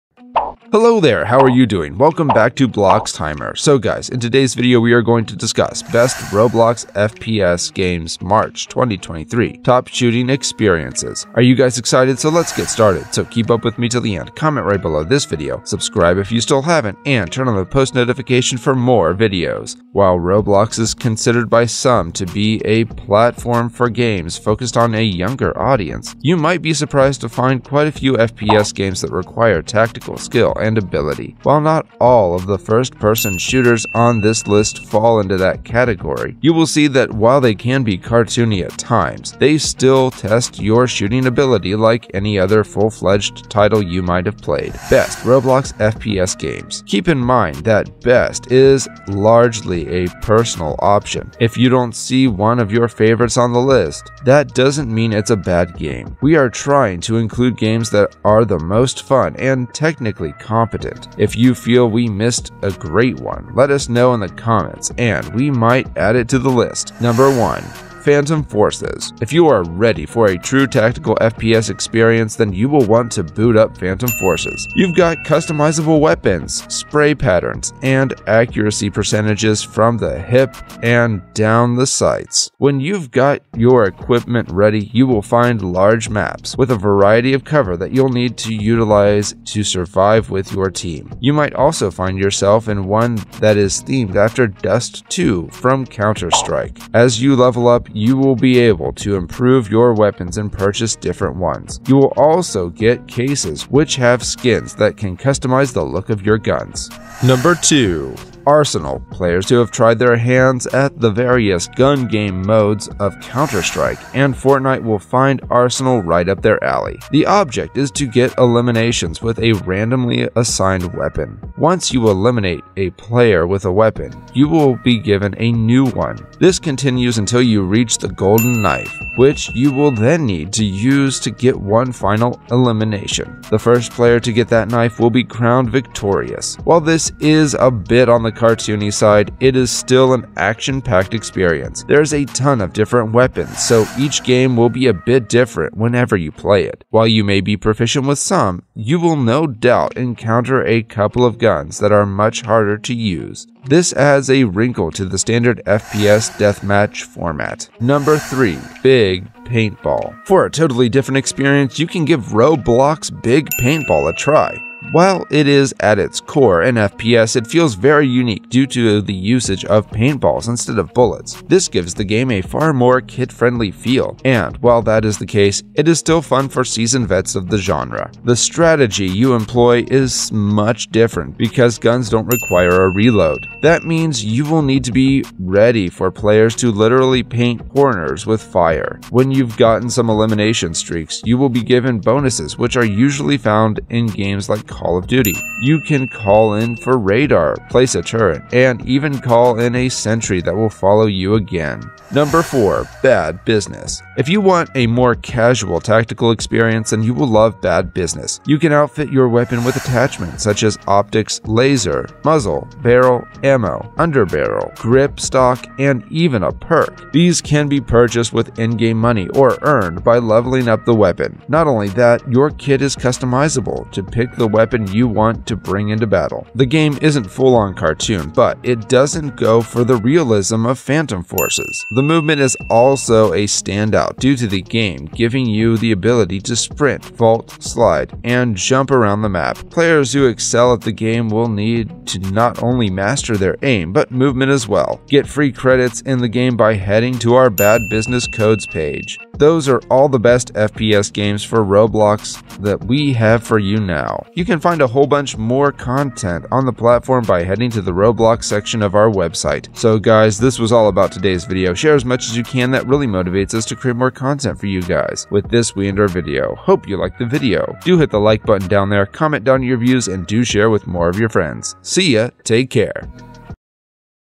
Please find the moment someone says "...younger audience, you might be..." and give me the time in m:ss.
0:25.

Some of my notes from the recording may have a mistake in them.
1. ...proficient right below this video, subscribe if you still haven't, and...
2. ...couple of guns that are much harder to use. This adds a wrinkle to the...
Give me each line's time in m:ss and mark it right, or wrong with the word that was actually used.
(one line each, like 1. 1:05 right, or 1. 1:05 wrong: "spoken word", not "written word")
1. 0:14 wrong: "comment", not "proficient"
2. 2:30 right.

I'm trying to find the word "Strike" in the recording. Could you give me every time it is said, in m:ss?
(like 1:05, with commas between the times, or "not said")
1:35, 1:53.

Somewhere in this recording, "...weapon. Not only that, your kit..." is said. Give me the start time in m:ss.
3:40.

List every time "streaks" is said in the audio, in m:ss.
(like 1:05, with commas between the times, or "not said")
3:10.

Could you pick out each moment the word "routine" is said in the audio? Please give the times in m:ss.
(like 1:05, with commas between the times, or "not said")
not said.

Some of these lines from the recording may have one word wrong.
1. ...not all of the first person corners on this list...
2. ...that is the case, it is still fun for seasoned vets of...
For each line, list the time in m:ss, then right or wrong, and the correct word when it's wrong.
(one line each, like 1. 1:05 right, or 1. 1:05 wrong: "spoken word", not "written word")
1. 0:31 wrong: "shooters", not "corners"
2. 2:54 right.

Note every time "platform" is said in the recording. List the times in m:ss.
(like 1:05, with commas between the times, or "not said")
0:22, 4:16.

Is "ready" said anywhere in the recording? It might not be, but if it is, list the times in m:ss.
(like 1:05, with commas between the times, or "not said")
1:09, 1:24, 3:05.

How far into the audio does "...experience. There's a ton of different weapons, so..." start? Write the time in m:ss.
2:21.